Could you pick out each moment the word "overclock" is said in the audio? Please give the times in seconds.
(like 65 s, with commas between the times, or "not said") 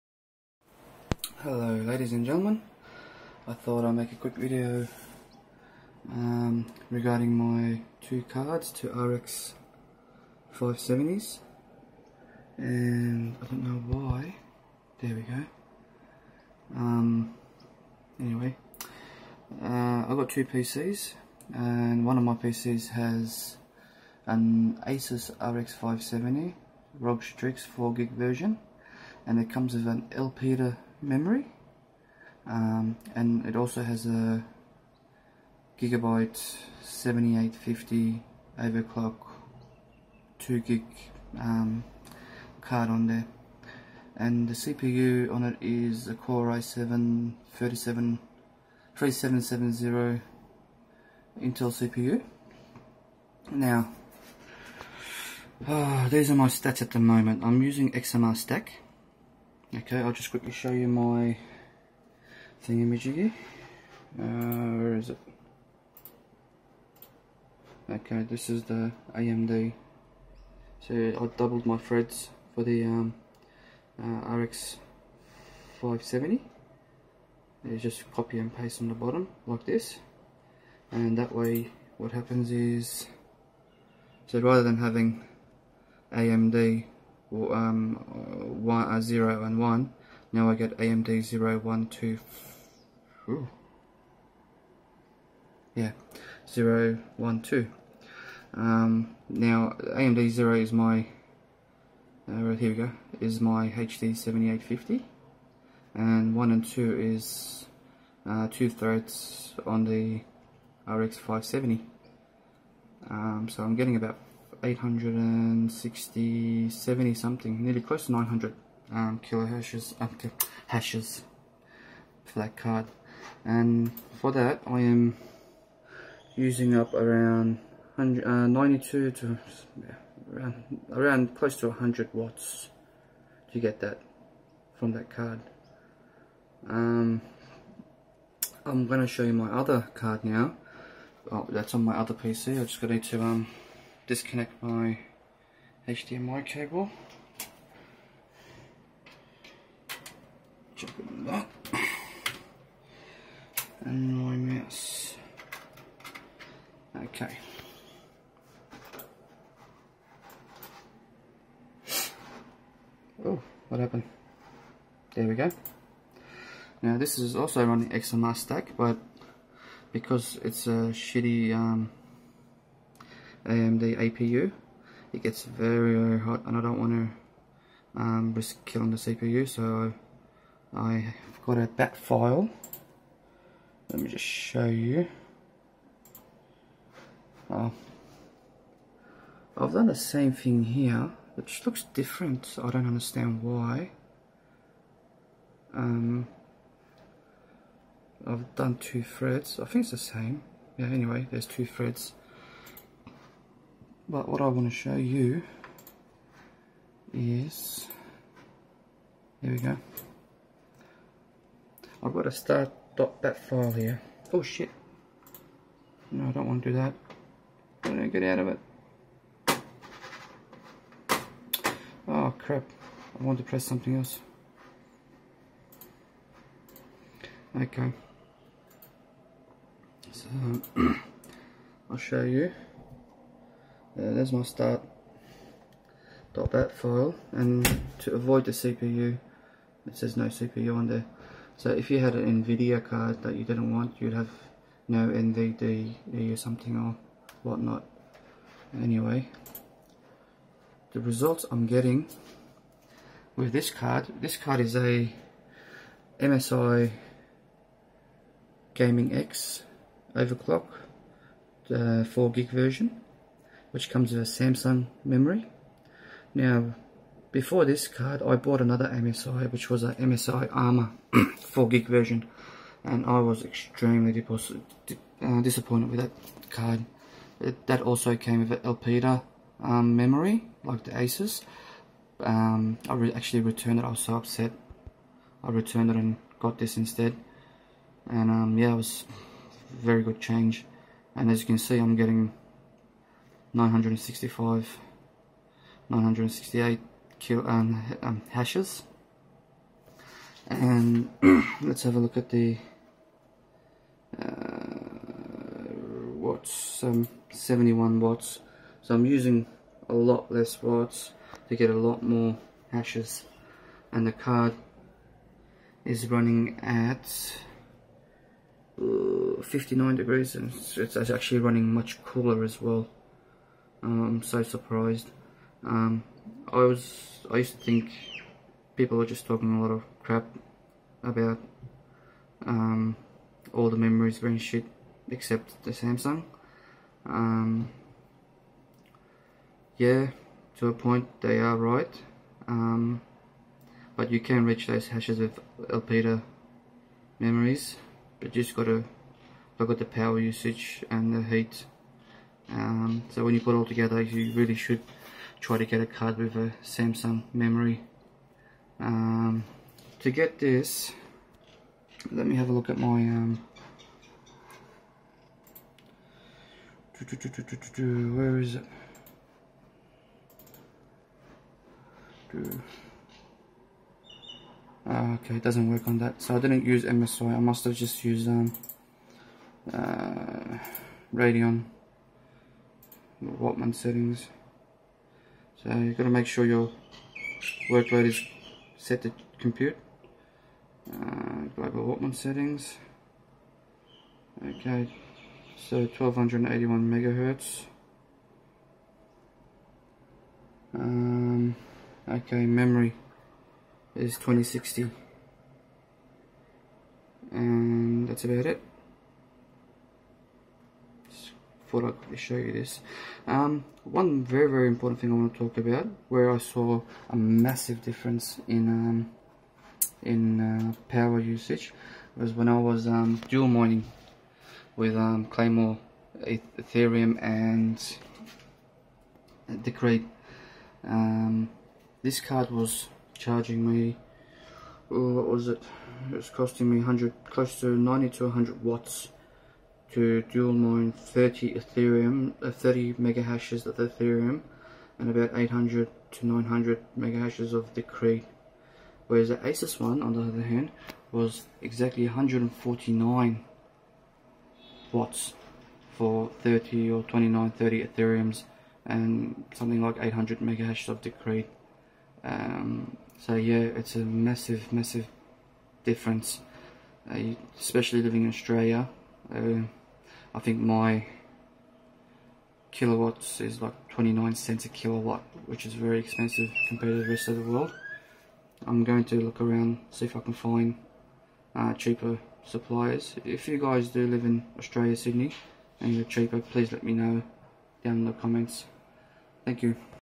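38 s, 260 s.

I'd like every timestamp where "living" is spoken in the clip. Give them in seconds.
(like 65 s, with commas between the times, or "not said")
468 s.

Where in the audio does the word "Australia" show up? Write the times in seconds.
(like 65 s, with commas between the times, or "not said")
468 s, 484 s.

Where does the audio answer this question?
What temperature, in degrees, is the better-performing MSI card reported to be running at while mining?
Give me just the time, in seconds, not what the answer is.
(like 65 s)
319 s.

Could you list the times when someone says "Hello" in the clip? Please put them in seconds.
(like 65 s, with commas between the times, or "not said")
1 s.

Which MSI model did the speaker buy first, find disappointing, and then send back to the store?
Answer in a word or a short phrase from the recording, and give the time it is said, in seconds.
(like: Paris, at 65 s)
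MSI Armor, at 269 s.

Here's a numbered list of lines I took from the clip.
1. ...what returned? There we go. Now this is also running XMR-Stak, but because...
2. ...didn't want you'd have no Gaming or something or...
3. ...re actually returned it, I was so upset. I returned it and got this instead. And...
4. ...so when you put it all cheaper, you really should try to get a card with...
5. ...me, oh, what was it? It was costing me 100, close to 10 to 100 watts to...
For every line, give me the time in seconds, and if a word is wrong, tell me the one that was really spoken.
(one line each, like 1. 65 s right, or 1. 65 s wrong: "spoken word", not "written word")
1. 163 s wrong: "happened", not "returned"
2. 243 s wrong: "NVDE", not "Gaming"
3. 282 s right
4. 353 s wrong: "together", not "cheaper"
5. 433 s wrong: "90", not "10".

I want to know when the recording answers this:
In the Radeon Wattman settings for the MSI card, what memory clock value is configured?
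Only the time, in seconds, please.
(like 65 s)
404 s.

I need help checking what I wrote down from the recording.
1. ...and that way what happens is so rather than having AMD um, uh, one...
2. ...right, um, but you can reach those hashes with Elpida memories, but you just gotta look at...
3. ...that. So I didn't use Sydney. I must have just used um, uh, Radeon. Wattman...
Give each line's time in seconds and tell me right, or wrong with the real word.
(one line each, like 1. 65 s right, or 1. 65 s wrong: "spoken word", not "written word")
1. 80 s right
2. 341 s right
3. 375 s wrong: "MSI", not "Sydney".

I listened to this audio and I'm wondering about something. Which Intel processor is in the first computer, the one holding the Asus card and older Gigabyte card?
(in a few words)
Core i7 3770.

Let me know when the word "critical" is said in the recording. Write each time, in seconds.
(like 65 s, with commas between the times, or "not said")
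not said.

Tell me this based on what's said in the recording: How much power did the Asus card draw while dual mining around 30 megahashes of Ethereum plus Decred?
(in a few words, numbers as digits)
149 watts.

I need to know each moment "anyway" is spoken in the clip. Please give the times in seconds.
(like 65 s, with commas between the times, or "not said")
18 s, 200 s, 248 s.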